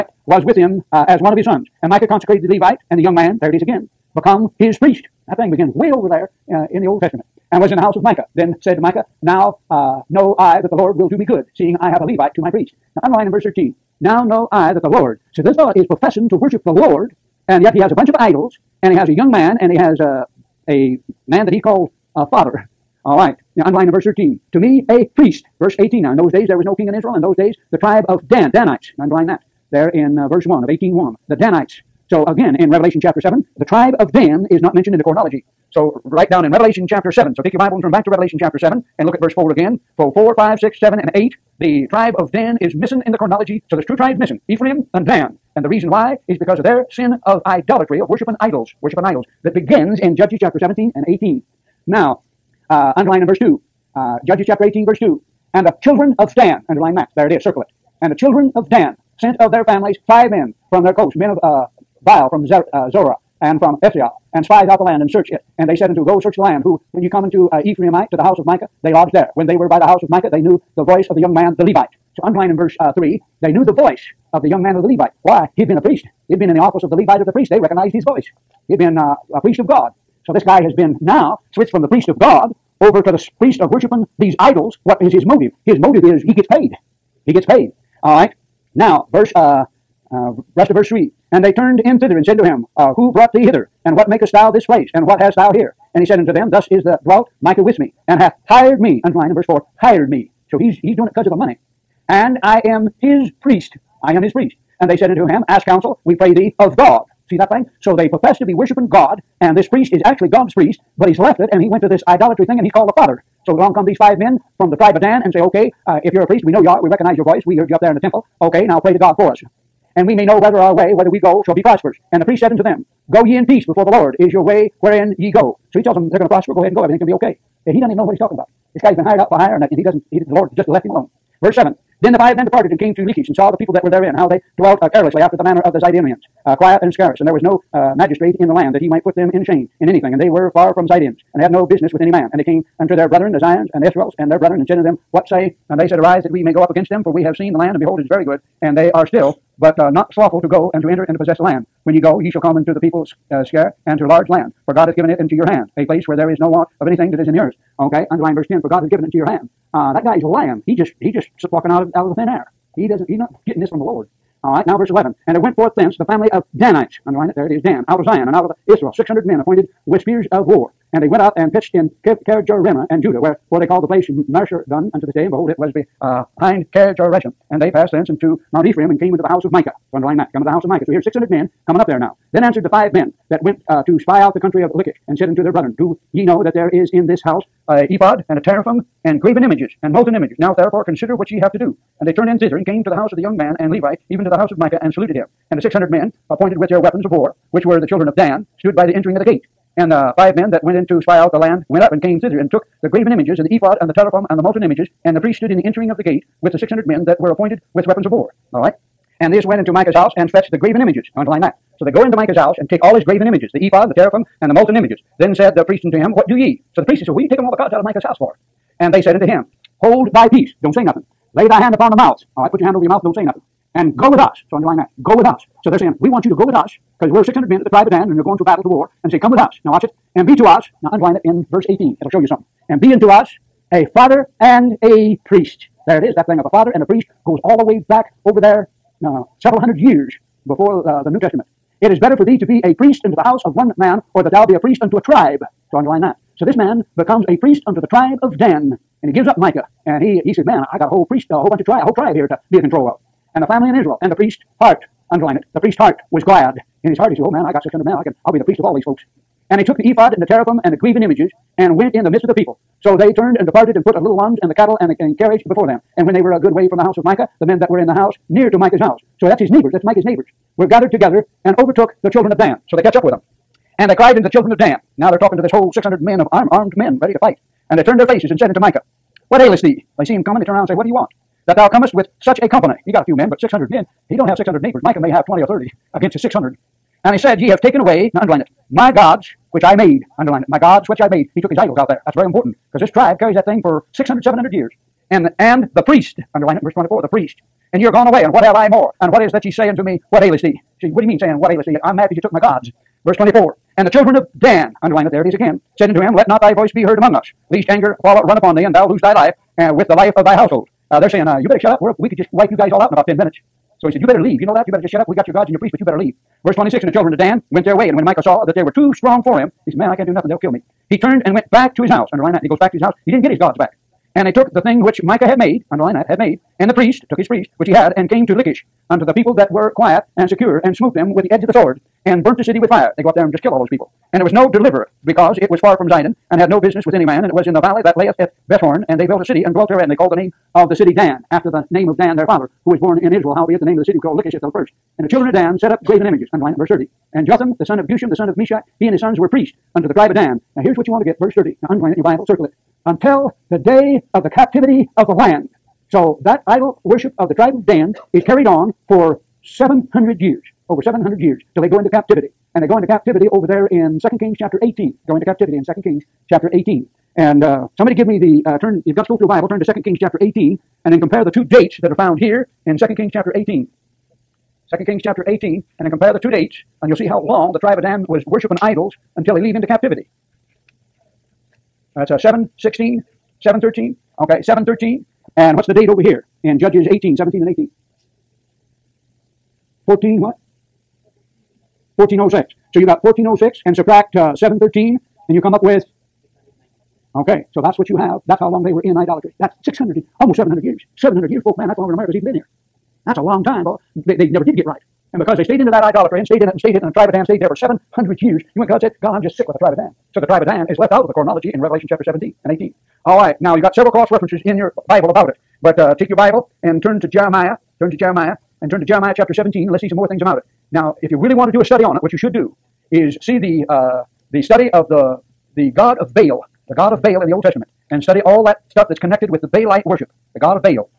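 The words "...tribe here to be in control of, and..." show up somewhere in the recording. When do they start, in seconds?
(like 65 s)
251 s.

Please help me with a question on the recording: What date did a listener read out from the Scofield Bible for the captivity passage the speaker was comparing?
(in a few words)
713.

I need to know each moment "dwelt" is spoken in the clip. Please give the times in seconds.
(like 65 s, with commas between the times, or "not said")
97 s, 134 s, 339 s.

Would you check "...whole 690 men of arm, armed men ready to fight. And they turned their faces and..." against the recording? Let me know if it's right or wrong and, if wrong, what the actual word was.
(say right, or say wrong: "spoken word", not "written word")
wrong: "600", not "690".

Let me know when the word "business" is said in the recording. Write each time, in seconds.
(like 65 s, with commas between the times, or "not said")
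141 s, 336 s.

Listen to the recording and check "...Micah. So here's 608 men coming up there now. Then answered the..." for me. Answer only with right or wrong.
wrong.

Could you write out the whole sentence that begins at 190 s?
Now therefore consider what ye have to do.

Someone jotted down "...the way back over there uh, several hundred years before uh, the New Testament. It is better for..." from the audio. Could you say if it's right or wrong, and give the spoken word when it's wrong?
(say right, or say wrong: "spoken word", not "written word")
right.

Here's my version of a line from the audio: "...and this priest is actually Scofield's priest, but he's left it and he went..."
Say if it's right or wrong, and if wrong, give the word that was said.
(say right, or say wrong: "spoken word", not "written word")
wrong: "God", not "Scofield".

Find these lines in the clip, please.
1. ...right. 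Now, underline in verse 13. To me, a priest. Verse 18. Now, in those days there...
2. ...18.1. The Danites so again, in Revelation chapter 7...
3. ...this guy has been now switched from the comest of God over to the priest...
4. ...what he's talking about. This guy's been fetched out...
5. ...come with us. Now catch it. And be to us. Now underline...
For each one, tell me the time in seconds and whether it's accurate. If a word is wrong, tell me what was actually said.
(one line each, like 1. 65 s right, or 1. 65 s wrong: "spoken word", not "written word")
1. 23 s right
2. 30 s right
3. 80 s wrong: "priest", not "comest"
4. 128 s wrong: "hired", not "fetched"
5. 229 s wrong: "watch", not "catch".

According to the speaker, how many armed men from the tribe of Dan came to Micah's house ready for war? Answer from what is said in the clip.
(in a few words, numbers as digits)
600.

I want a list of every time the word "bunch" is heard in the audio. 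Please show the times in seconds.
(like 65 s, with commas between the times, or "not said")
17 s, 251 s.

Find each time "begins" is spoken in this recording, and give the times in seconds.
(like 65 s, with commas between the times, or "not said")
5 s, 49 s.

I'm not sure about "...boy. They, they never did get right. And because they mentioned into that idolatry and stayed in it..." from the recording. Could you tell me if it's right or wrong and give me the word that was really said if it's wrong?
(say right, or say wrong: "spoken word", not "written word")
wrong: "stayed", not "mentioned".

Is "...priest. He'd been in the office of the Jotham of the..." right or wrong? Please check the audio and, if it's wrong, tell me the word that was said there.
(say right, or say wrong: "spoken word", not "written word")
wrong: "Levite", not "Jotham".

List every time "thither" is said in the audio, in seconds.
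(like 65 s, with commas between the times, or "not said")
91 s, 192 s, 202 s.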